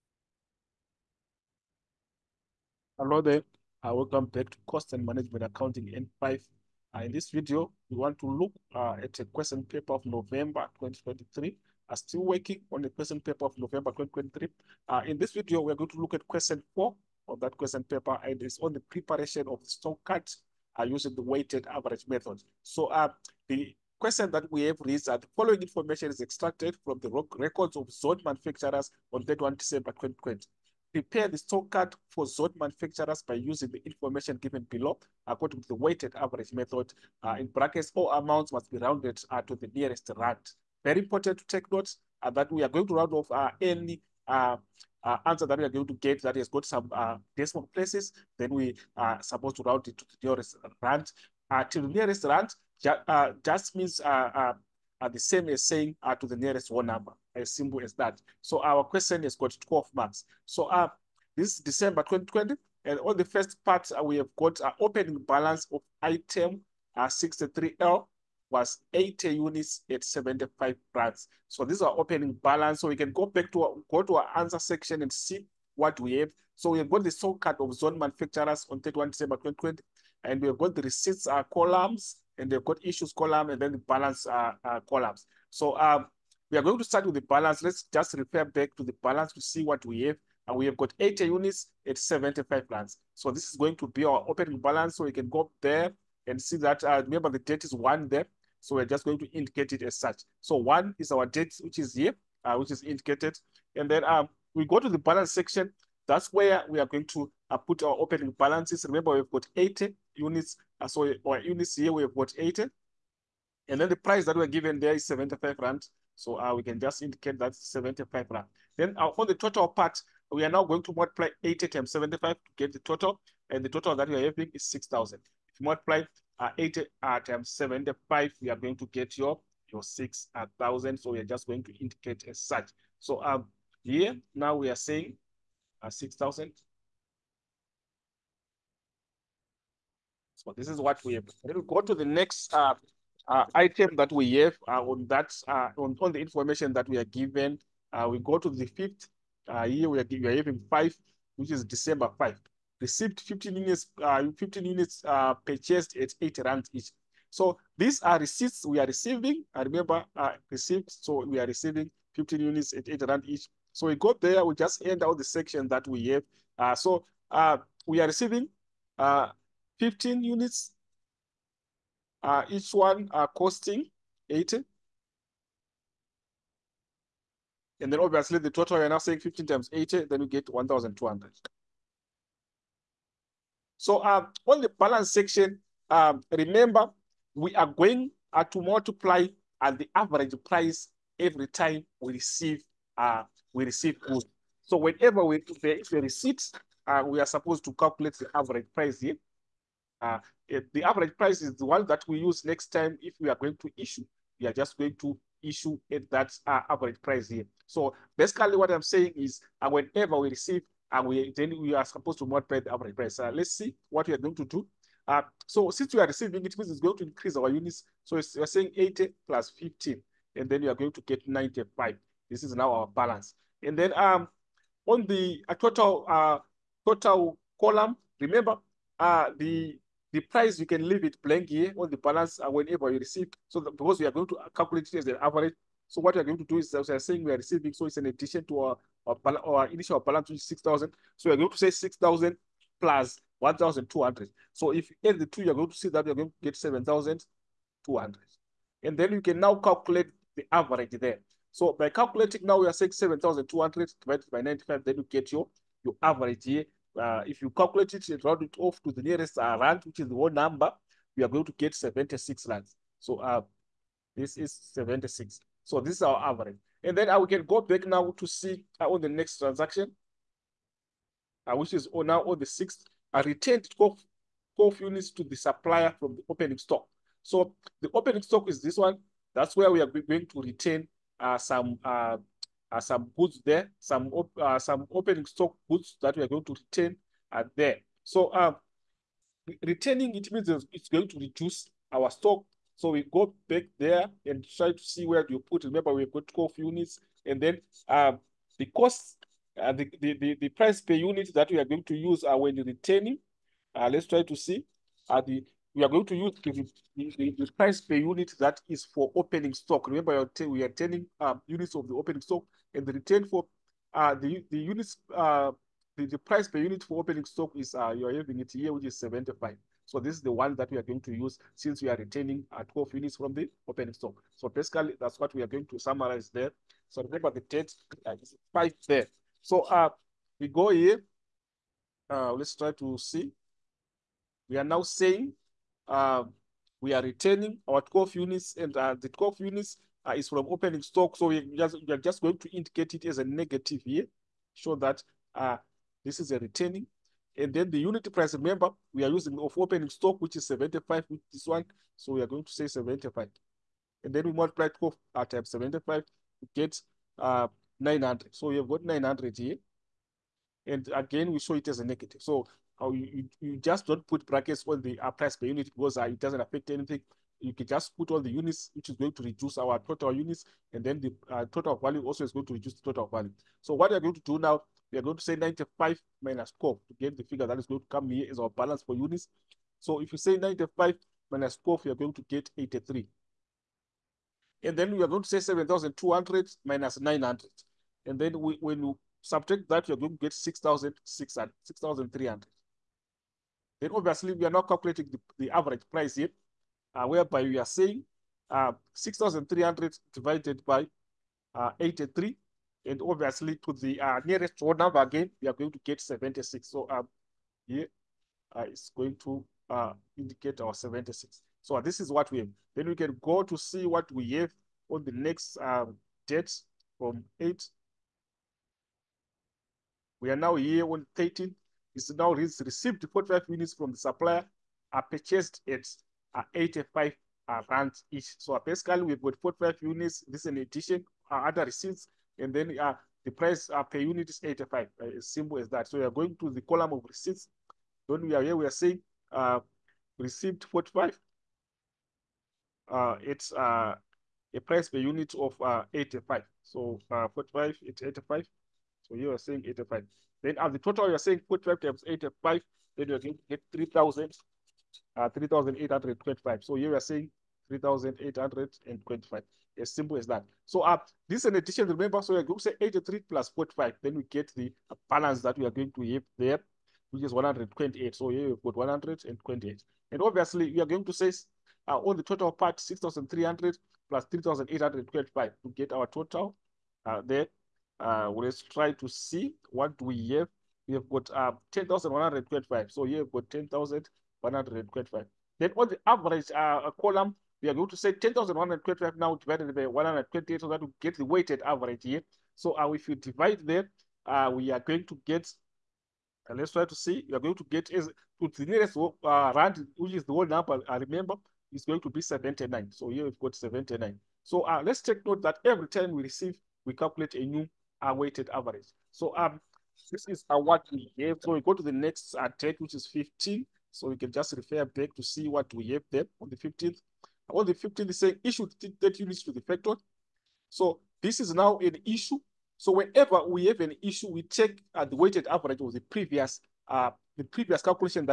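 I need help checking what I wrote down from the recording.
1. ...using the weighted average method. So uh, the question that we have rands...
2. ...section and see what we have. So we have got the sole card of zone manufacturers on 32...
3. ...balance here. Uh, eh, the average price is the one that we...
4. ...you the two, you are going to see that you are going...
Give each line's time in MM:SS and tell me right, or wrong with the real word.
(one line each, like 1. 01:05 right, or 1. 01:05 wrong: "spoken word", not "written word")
1. 00:20 wrong: "reads", not "rands"
2. 01:14 wrong: "31", not "32"
3. 03:18 wrong: "price", not "balance"
4. 04:05 right.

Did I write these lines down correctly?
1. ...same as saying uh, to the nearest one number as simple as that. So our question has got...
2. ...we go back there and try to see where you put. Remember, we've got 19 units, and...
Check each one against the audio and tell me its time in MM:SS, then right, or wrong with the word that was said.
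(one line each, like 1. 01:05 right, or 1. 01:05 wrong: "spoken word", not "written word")
1. 00:55 right
2. 04:52 wrong: "12", not "19".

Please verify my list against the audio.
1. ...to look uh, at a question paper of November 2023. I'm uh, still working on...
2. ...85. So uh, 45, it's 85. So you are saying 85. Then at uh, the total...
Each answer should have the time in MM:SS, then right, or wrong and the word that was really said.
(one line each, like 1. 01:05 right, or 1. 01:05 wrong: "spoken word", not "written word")
1. 00:08 right
2. 07:25 right.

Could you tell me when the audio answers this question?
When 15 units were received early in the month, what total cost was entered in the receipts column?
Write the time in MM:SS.
03:00.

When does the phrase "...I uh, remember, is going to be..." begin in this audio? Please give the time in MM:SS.
08:20.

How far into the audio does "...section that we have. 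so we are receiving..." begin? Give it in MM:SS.
02:45.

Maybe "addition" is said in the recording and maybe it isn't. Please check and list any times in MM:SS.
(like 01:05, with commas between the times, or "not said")
03:58, 07:10.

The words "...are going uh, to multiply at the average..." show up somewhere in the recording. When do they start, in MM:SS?
03:07.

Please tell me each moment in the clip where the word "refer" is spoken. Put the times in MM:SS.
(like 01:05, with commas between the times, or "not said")
01:28, 08:34.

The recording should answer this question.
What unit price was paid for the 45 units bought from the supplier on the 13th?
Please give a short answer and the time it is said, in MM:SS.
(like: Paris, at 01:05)
85 rand, at 07:06.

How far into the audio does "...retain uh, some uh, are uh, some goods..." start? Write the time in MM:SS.
04:40.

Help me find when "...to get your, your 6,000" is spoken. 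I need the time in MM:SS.
02:08.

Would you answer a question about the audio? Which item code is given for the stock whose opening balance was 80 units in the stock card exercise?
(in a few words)
63L.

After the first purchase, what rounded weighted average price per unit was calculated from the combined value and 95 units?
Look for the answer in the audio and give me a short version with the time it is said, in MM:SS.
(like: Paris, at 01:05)
76 rand, at 04:21.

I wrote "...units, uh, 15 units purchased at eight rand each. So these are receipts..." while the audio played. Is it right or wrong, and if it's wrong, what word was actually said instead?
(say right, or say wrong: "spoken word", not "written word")
right.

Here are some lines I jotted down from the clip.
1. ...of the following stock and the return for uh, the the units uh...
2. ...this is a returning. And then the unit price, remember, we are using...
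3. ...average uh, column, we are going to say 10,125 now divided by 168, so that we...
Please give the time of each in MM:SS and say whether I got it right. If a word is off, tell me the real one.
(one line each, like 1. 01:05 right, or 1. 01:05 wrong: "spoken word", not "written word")
1. 05:11 wrong: "opening", not "following"
2. 05:46 right
3. 08:06 wrong: "128", not "168".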